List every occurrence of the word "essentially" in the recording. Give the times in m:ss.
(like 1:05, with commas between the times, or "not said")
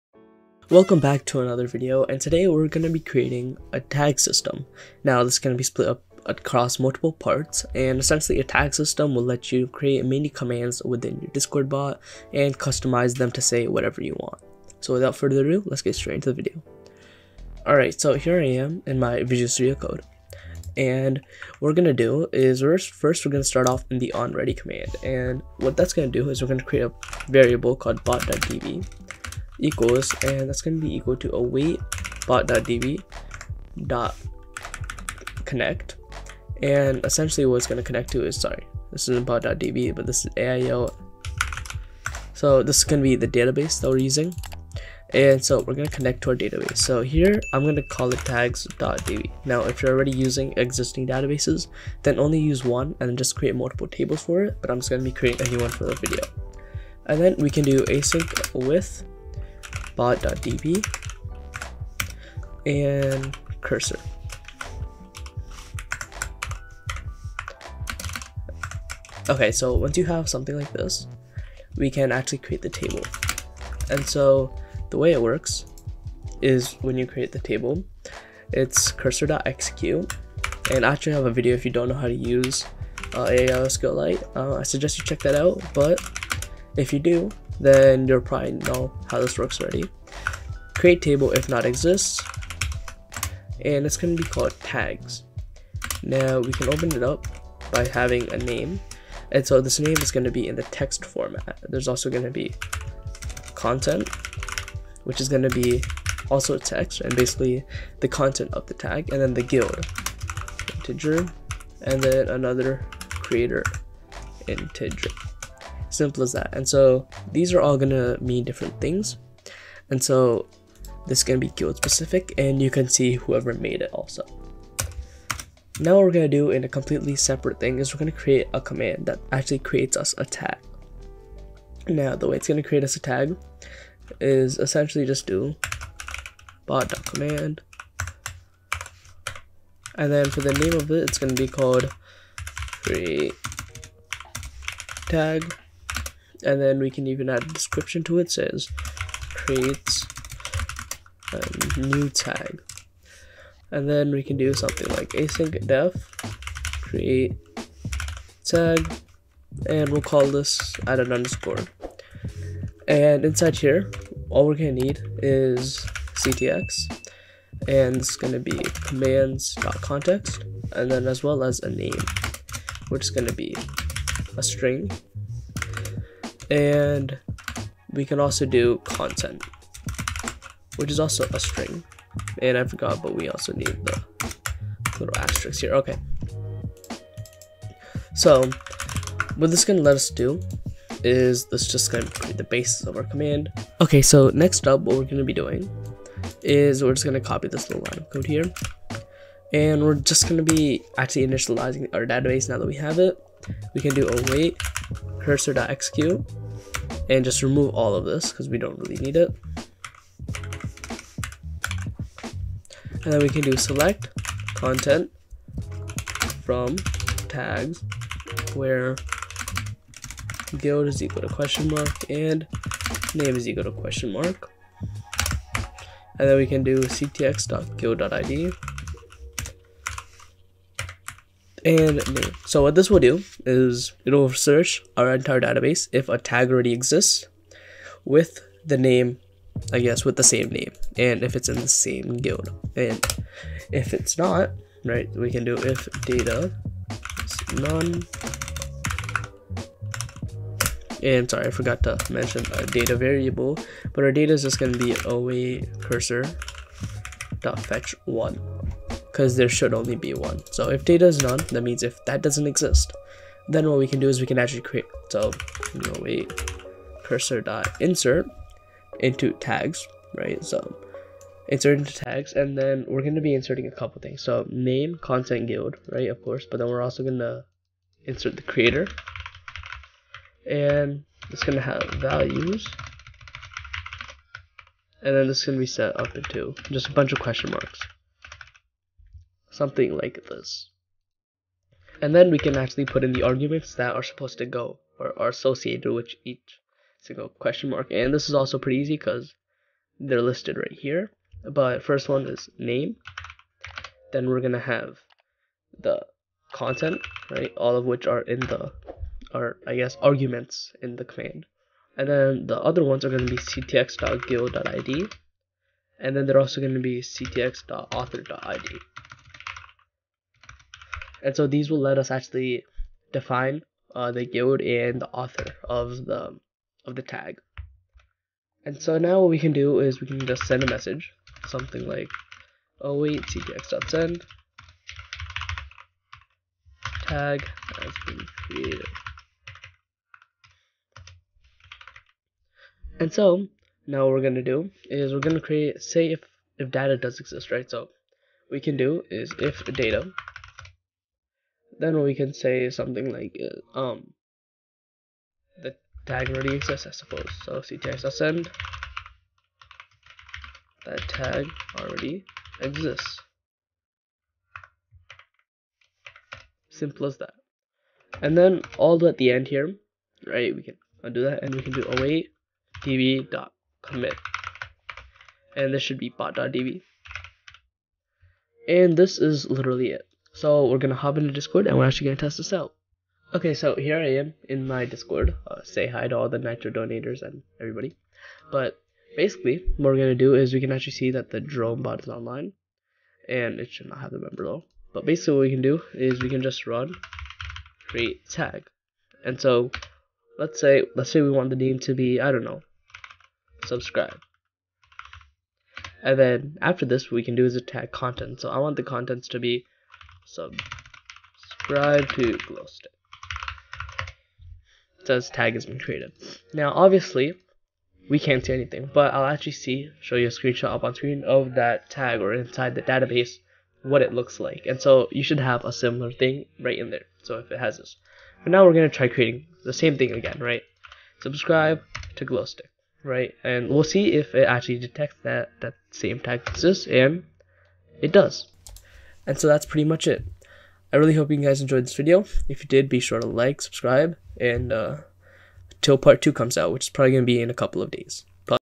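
0:07, 0:37, 2:14.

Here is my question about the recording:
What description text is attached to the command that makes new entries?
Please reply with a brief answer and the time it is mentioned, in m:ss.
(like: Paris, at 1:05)
Creates a new tag, at 2:29.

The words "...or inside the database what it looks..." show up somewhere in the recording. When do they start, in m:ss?
7:02.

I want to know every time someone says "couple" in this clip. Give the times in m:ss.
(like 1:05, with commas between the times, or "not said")
4:33, 7:27.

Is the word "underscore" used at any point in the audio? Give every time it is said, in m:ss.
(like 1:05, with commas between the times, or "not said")
2:41.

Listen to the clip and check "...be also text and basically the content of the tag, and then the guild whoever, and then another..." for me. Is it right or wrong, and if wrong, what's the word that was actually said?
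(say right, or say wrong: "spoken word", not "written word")
wrong: "integer", not "whoever".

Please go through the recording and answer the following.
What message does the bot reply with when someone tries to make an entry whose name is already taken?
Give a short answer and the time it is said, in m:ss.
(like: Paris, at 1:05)
That tag already exists, at 6:00.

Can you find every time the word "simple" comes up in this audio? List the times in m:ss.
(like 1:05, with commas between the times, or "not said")
1:55, 6:06.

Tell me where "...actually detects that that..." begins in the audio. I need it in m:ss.
7:14.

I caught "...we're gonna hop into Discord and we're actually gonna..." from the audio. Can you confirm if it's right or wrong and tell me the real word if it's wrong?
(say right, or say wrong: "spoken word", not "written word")
right.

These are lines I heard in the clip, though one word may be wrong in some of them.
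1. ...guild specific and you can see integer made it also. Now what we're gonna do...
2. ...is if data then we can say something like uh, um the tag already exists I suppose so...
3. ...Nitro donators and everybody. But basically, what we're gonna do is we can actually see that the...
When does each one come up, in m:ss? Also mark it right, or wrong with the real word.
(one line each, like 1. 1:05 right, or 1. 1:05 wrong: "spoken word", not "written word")
1. 2:01 wrong: "whoever", not "integer"
2. 5:49 right
3. 6:26 right.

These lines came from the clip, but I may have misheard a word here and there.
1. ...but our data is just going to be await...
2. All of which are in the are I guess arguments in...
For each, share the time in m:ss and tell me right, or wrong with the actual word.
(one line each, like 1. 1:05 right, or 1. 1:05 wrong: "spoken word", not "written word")
1. 4:13 right
2. 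5:07 right.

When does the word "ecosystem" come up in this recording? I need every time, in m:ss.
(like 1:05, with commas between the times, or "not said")
not said.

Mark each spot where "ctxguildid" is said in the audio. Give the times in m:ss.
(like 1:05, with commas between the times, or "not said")
3:46, 5:13.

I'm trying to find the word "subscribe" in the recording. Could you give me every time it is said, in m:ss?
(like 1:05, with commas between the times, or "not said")
6:43, 6:50, 7:11, 7:23.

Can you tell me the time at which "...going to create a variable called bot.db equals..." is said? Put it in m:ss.
0:26.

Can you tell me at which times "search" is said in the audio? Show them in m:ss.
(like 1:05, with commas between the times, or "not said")
3:54.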